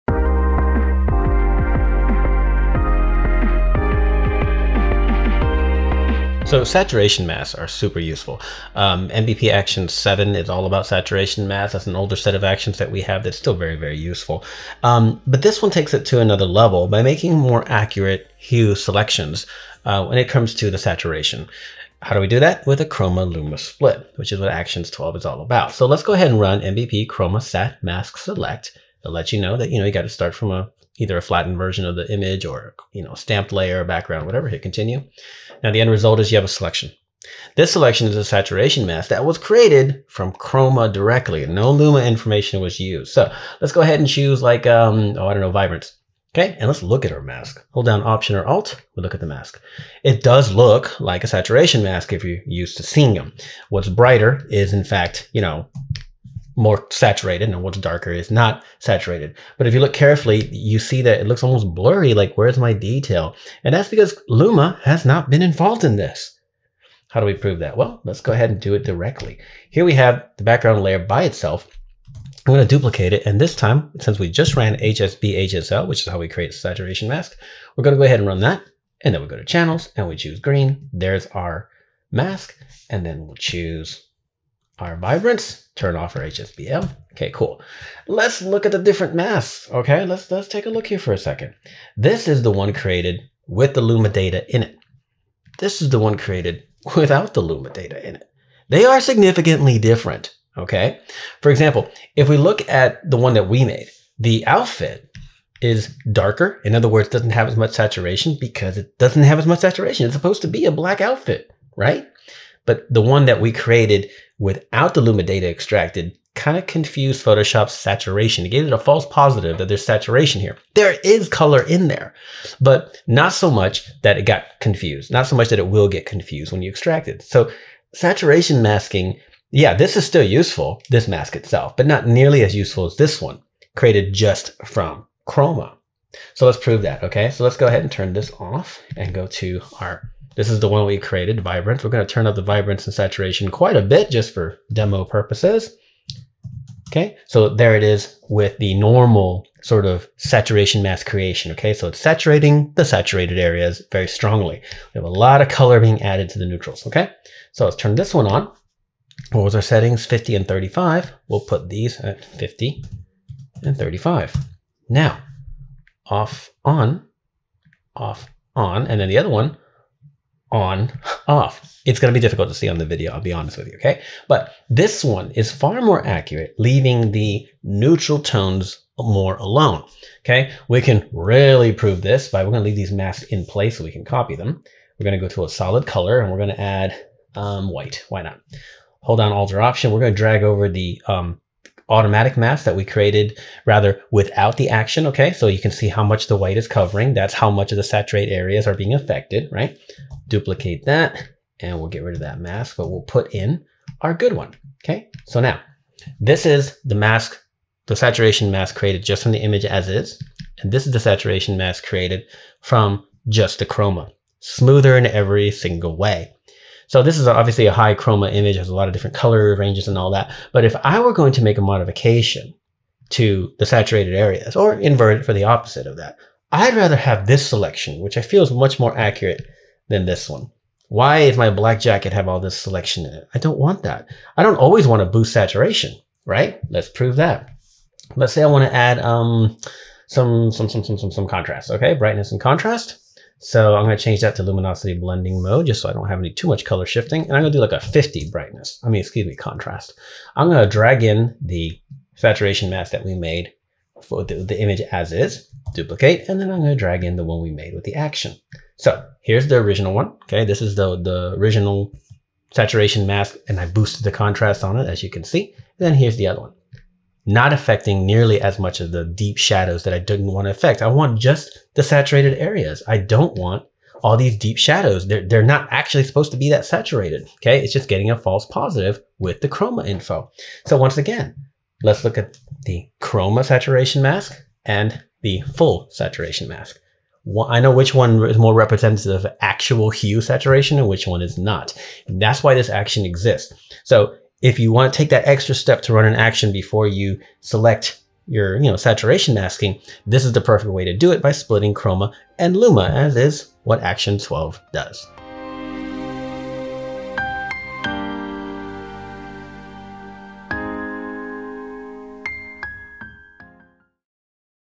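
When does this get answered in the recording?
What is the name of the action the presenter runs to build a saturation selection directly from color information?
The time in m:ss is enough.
0:26.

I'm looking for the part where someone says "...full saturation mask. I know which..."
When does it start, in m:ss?
4:45.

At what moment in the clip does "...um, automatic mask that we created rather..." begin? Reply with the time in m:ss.
3:11.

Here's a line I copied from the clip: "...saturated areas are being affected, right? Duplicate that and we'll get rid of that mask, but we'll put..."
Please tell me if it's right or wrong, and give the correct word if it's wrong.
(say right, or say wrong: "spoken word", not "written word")
right.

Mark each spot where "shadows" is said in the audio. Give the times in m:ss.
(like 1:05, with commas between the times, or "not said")
4:29, 4:34.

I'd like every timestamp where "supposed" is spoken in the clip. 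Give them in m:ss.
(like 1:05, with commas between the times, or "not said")
1:50, 4:36.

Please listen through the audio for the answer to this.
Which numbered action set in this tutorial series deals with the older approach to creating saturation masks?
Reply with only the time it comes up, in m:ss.
0:09.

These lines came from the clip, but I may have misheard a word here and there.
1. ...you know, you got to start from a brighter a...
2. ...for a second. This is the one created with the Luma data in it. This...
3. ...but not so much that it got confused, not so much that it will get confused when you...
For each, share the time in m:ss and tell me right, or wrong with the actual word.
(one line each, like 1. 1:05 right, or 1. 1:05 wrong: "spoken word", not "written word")
1. 0:29 wrong: "either", not "brighter"
2. 1:30 right
3. 2:02 right.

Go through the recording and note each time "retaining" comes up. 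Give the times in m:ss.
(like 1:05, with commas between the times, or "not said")
not said.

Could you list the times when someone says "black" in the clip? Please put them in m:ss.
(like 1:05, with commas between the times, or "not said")
1:50, 3:51.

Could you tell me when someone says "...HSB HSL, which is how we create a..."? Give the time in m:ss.
1:14.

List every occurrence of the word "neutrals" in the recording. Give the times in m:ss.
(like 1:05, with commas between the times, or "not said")
2:36, 2:57.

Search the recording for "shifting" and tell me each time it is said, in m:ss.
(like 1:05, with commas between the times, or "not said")
4:06.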